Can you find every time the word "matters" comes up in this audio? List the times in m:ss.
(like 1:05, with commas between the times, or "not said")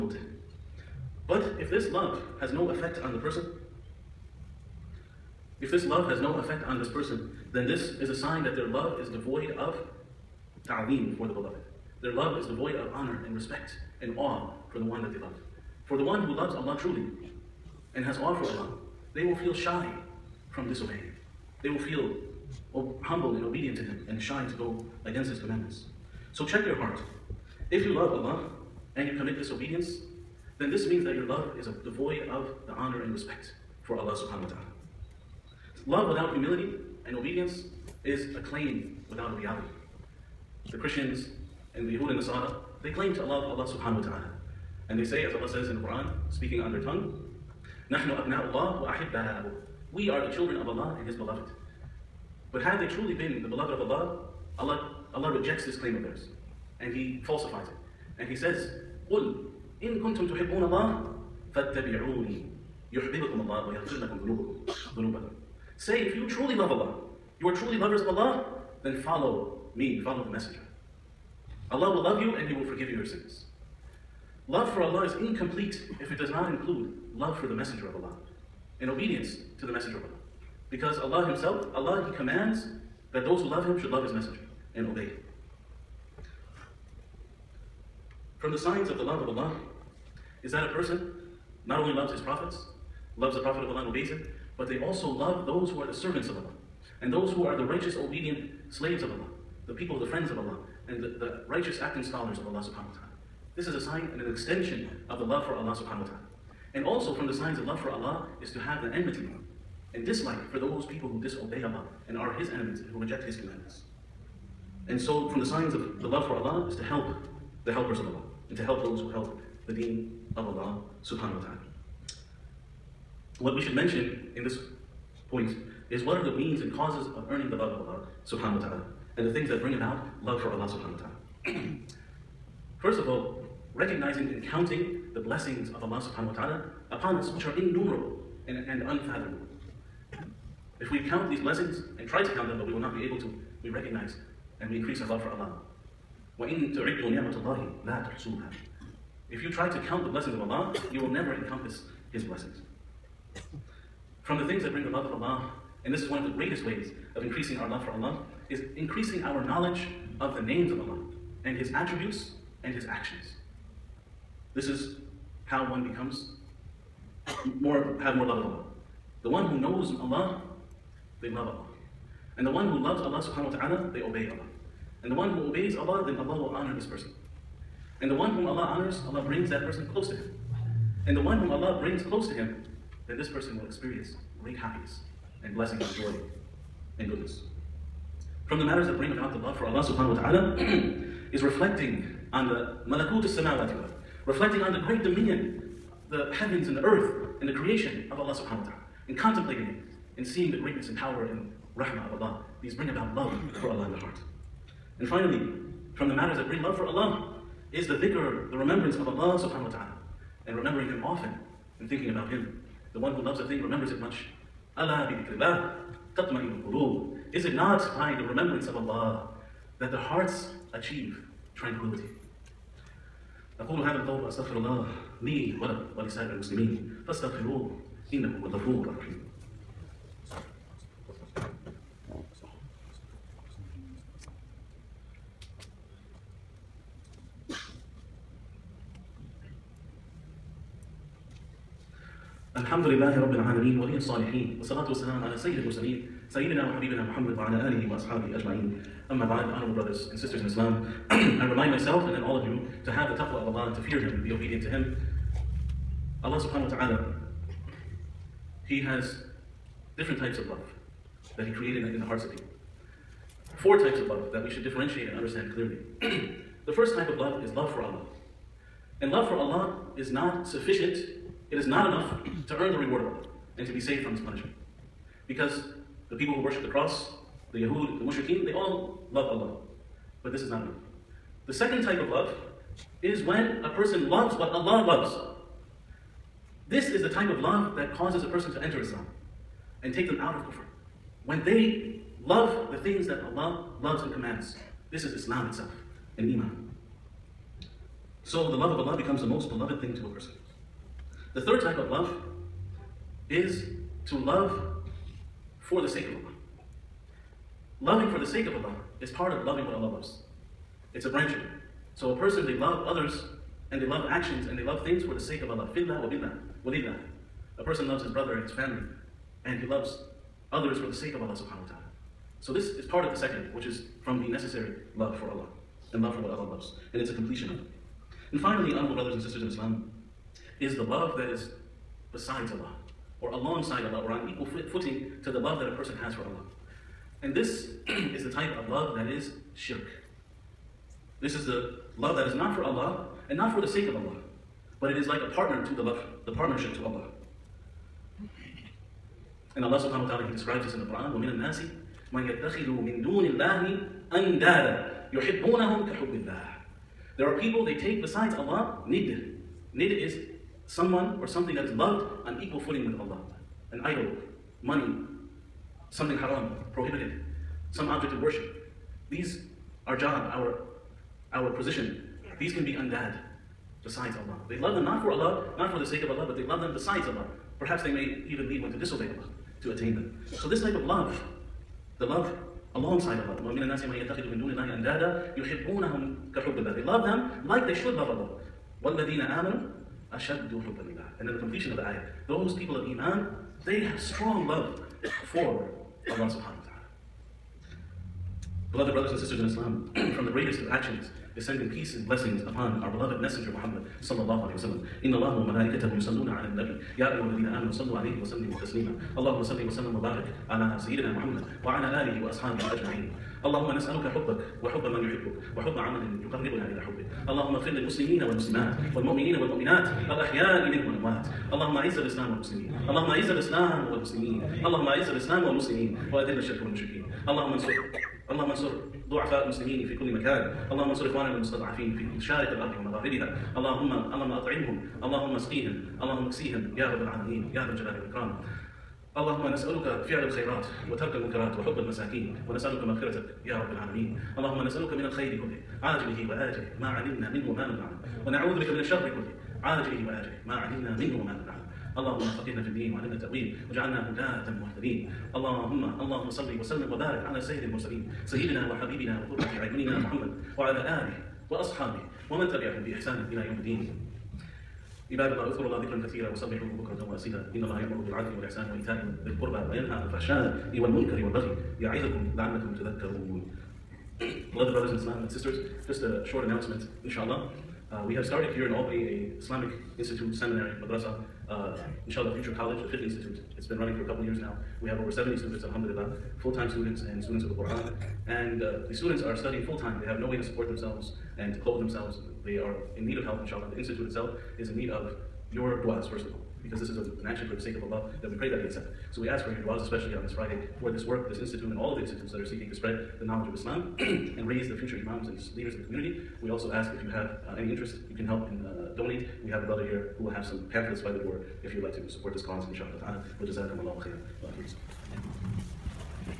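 3:08, 3:26.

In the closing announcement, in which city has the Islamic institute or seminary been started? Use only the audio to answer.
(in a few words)
Albany.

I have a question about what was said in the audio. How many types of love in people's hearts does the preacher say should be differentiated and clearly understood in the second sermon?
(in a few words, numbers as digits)
4.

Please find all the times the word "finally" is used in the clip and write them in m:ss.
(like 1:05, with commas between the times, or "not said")
3:25, 5:28.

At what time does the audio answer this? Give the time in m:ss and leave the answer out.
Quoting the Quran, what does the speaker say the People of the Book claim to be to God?
0:49.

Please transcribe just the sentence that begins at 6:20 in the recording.
So this type of love, the love alongside Allah.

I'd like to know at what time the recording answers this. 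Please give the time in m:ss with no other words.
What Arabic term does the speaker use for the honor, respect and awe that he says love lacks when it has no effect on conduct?
0:10.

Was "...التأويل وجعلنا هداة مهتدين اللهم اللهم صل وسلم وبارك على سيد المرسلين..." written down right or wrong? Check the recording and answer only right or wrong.
right.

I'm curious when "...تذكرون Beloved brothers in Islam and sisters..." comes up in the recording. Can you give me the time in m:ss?
7:52.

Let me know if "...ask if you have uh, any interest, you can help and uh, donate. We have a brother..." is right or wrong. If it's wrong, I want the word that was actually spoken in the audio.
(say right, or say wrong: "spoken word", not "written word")
right.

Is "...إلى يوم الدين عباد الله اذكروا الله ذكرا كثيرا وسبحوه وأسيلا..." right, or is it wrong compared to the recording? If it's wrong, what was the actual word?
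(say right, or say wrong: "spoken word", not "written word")
right.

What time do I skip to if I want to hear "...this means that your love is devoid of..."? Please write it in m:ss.
0:30.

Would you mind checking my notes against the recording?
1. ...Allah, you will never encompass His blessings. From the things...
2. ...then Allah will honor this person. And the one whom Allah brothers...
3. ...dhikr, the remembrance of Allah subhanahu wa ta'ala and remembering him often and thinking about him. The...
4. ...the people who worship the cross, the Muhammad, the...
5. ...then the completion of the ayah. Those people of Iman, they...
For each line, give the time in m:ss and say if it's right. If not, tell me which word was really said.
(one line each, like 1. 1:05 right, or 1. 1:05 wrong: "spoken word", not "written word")
1. 2:30 right
2. 2:56 wrong: "honors", not "brothers"
3. 3:28 right
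4. 4:36 wrong: "Yahud", not "Muhammad"
5. 6:31 right.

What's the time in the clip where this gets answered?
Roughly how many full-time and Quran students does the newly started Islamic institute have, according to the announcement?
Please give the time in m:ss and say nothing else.
8:04.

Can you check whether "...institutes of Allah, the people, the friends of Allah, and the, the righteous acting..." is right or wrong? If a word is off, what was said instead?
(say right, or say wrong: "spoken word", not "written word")
wrong: "slaves", not "institutes".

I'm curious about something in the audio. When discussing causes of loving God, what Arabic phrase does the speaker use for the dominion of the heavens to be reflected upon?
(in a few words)
malakut samawati.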